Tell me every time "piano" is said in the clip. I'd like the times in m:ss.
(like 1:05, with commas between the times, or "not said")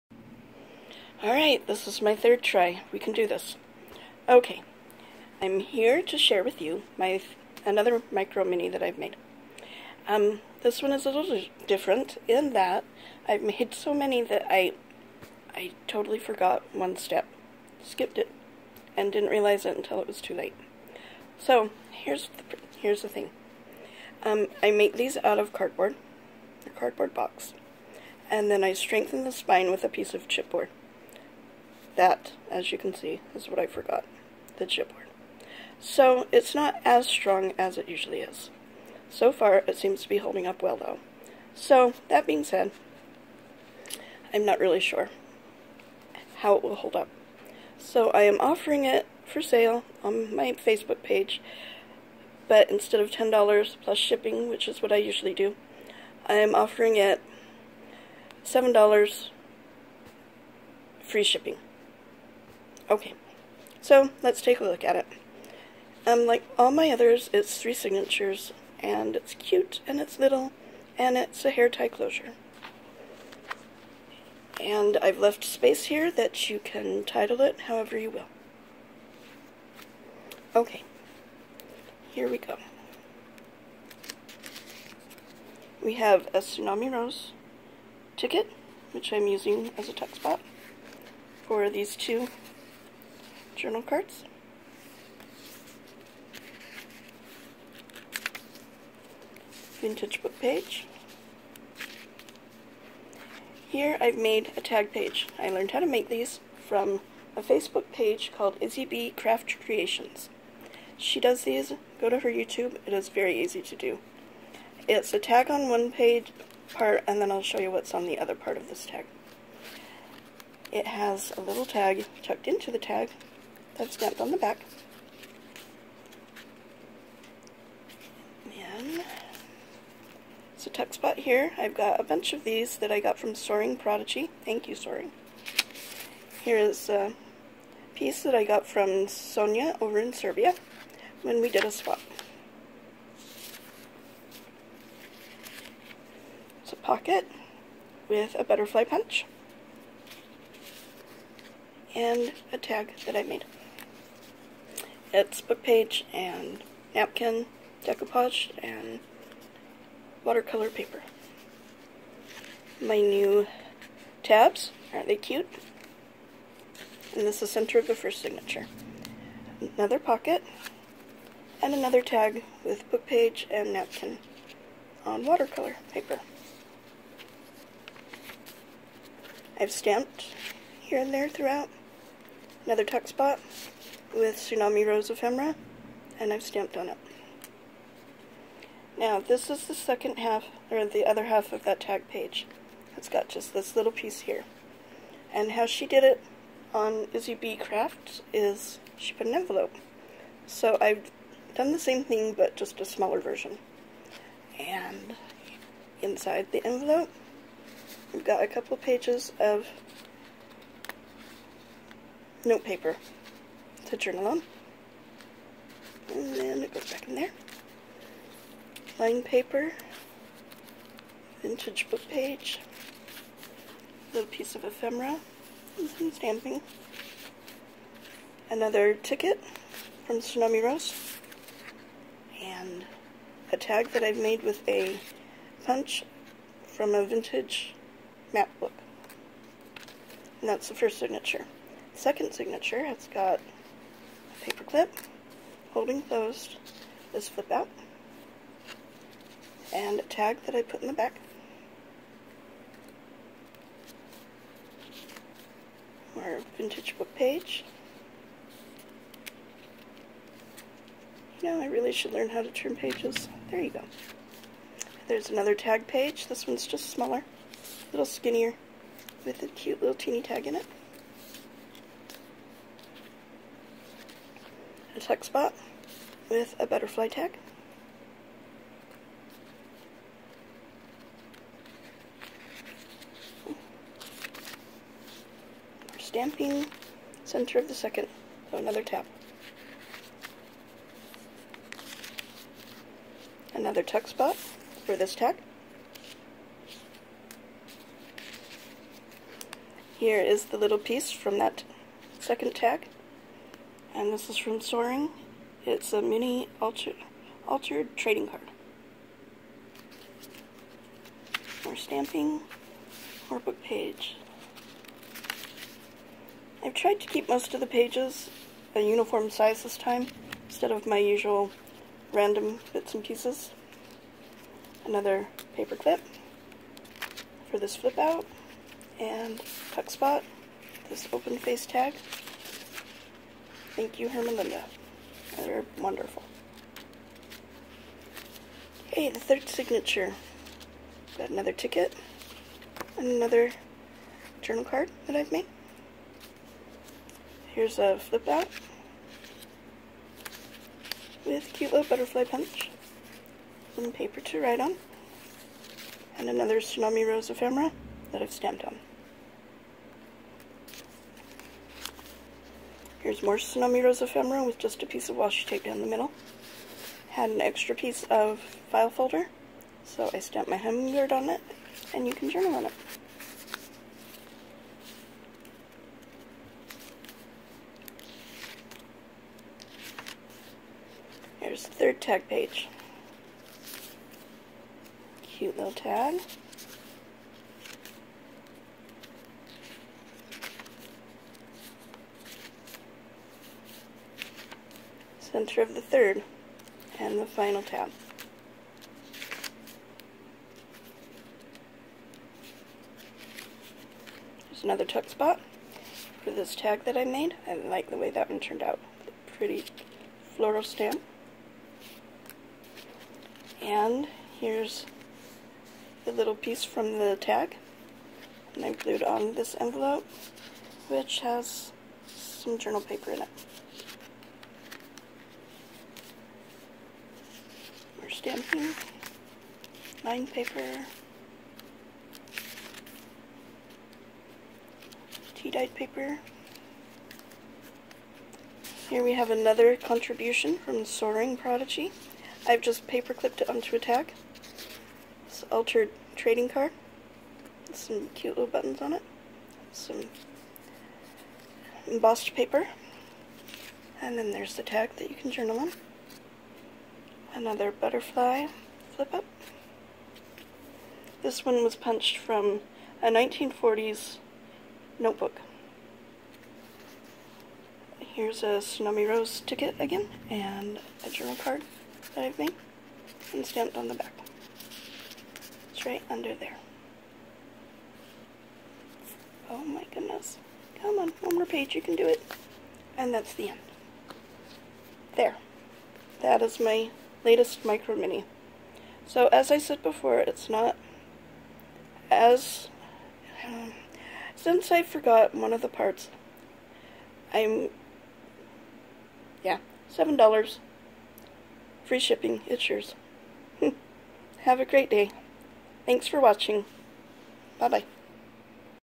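not said.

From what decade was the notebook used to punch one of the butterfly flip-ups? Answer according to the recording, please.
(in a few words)
1940s.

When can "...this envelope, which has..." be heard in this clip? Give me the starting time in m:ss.
6:59.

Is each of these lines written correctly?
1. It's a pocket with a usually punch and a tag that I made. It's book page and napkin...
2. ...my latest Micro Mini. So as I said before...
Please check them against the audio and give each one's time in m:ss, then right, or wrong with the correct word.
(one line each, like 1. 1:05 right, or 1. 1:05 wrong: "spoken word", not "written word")
1. 2:26 wrong: "butterfly", not "usually"
2. 8:06 right.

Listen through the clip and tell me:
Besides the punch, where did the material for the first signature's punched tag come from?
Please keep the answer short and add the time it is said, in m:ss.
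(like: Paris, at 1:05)
a vintage map book, at 3:57.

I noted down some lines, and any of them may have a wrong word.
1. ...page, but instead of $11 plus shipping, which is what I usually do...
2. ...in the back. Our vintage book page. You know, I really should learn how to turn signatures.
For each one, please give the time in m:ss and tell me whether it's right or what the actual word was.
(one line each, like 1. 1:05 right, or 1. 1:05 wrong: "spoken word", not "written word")
1. 0:51 wrong: "10", not "11"
2. 4:10 wrong: "pages", not "signatures".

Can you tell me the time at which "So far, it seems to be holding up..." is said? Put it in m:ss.
0:39.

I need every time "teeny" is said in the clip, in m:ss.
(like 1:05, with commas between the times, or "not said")
4:29.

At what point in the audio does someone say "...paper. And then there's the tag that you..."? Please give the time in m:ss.
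7:32.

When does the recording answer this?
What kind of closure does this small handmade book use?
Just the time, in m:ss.
1:11.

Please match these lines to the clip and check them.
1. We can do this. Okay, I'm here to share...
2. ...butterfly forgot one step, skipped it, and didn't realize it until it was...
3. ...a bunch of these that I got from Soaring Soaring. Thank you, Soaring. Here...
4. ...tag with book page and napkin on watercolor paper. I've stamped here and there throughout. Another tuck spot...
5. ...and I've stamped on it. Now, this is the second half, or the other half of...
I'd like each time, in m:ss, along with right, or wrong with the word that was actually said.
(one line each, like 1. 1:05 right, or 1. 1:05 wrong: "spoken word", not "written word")
1. 0:02 right
2. 0:15 wrong: "totally", not "butterfly"
3. 2:11 wrong: "Prodigy", not "Soaring"
4. 2:52 right
5. 3:06 right.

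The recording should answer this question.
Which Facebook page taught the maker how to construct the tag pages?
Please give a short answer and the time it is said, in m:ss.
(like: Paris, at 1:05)
Izzy B Craft Creations, at 1:48.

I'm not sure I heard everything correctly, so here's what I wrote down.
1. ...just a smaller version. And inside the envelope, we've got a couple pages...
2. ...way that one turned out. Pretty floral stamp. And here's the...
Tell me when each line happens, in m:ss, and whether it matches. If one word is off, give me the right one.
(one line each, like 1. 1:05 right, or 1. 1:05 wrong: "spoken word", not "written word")
1. 3:22 right
2. 6:47 right.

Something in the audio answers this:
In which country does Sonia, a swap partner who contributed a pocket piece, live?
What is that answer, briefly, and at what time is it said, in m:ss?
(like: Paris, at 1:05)
Serbia, at 2:20.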